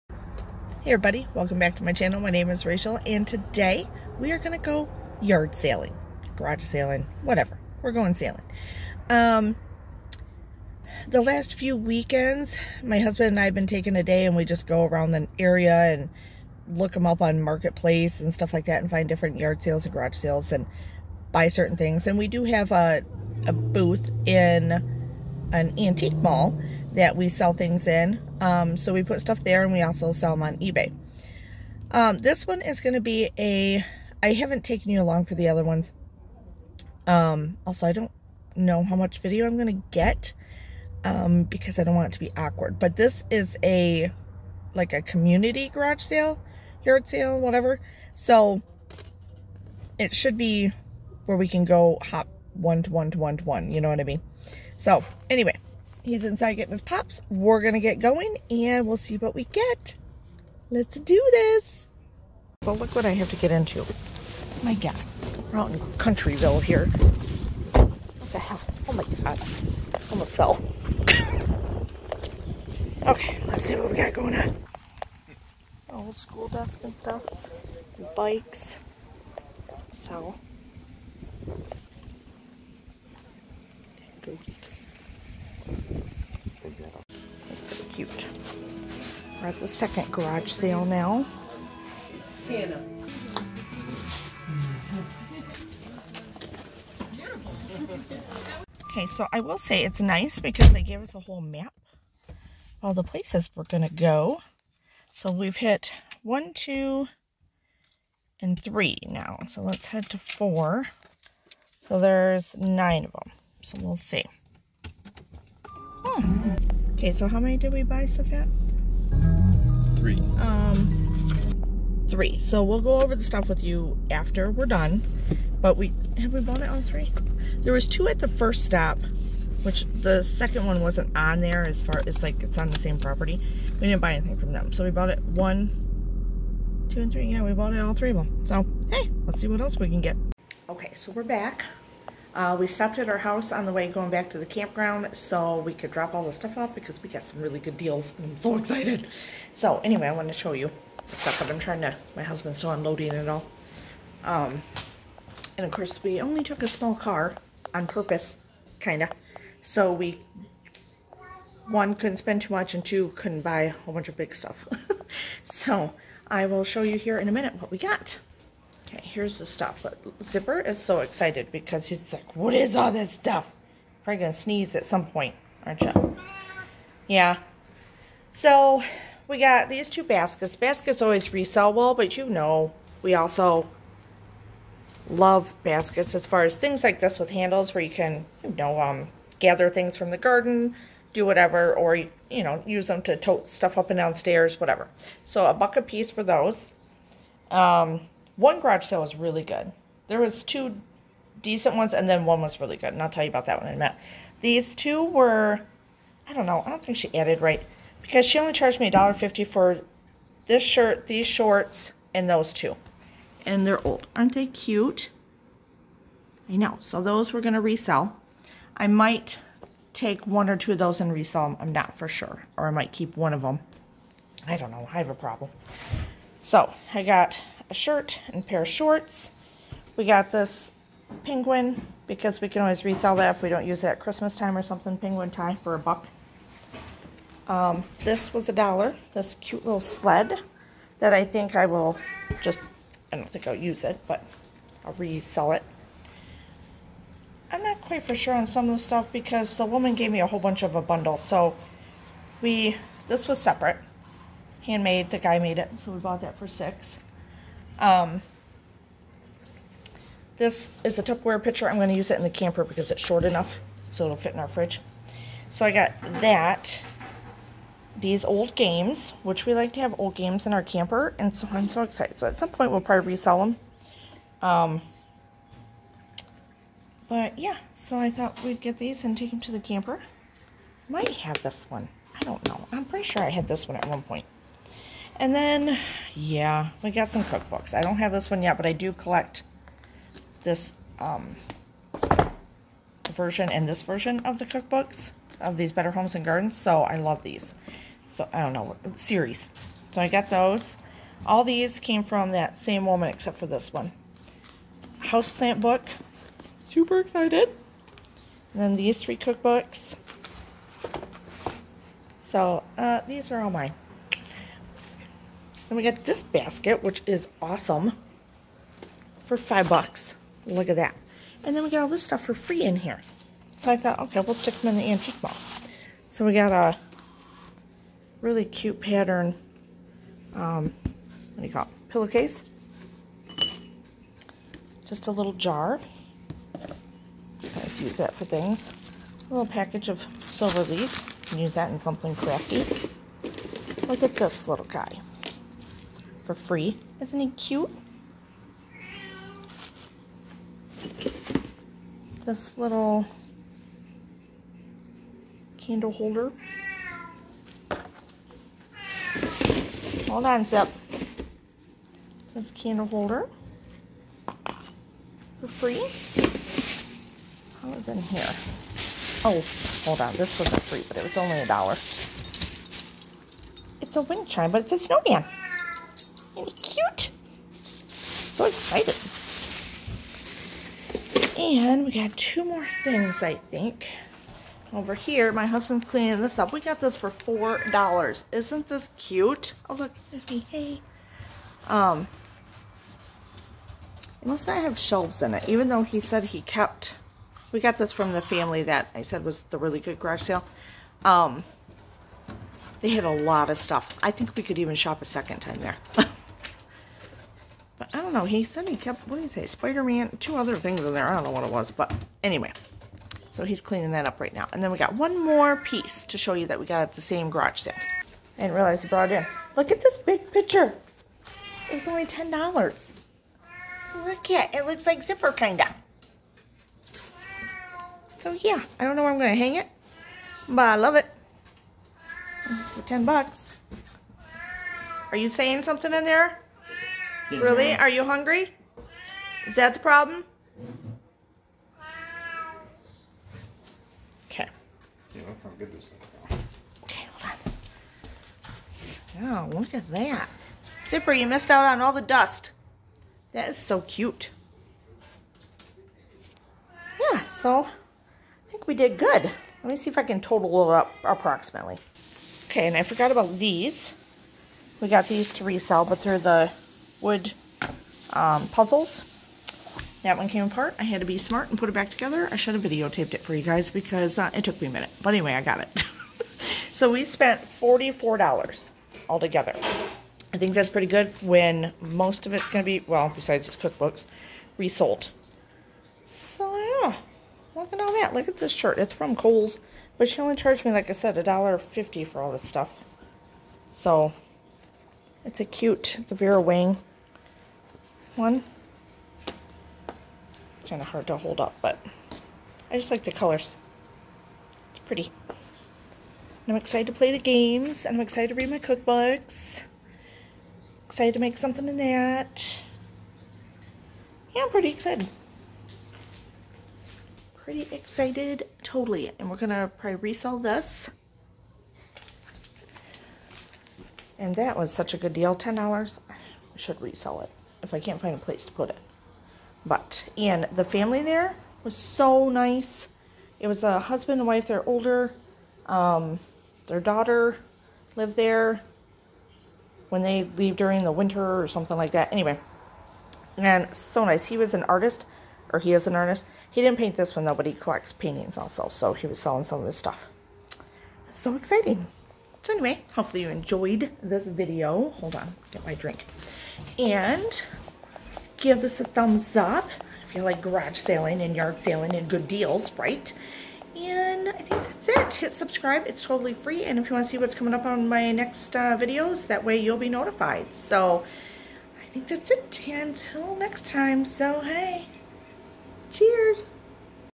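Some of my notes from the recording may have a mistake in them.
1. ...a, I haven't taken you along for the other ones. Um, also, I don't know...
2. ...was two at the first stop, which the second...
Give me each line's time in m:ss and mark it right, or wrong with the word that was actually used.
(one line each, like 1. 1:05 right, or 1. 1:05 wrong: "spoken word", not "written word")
1. 0:33 right
2. 2:07 right.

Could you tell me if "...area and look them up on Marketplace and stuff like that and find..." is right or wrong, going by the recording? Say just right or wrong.
right.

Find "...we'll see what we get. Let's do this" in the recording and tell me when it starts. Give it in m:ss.
0:58.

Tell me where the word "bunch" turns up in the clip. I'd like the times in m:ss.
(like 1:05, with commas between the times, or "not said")
2:43, 4:10.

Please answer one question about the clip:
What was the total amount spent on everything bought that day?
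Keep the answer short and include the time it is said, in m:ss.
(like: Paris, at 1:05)
$44, at 7:57.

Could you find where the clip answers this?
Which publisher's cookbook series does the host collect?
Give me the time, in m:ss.
4:55.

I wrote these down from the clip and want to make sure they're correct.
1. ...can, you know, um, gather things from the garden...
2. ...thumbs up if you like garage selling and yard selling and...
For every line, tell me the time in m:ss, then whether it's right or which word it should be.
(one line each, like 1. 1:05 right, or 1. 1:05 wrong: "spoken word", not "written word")
1. 3:07 right
2. 9:18 right.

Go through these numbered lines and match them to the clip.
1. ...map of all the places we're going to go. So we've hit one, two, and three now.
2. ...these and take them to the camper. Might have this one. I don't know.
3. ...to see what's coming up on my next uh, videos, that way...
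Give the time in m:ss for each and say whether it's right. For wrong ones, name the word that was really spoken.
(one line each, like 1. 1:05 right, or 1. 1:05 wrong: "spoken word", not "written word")
1. 1:41 right
2. 4:38 right
3. 9:27 right.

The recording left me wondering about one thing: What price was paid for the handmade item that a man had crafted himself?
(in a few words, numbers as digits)
$6.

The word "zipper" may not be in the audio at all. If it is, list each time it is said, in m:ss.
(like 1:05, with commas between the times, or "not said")
2:50, 7:05, 7:30.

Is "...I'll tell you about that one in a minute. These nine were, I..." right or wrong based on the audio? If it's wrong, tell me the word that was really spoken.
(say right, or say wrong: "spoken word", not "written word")
wrong: "two", not "nine".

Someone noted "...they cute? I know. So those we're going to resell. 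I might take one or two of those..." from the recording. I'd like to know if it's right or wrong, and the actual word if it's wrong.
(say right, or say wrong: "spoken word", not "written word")
right.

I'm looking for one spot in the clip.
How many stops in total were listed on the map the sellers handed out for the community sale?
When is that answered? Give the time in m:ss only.
1:52.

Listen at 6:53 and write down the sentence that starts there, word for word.
So he's cleaning that up right now.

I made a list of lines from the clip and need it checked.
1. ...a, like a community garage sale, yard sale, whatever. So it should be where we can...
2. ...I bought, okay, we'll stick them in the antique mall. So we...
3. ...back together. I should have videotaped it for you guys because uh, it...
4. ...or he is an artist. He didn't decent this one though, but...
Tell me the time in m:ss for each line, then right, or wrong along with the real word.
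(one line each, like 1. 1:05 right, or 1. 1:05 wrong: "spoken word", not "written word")
1. 0:43 right
2. 5:23 wrong: "thought", not "bought"
3. 7:51 right
4. 9:05 wrong: "paint", not "decent".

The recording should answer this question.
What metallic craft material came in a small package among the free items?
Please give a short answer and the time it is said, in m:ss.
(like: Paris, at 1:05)
Silver leaf, at 5:40.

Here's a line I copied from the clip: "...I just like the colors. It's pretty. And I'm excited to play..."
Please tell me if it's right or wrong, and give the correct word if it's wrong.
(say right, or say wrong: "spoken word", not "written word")
right.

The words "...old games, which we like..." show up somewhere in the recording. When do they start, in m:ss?
4:28.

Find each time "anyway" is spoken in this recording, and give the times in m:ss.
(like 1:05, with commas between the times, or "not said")
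0:55, 2:29, 6:52, 7:55, 9:02, 9:12.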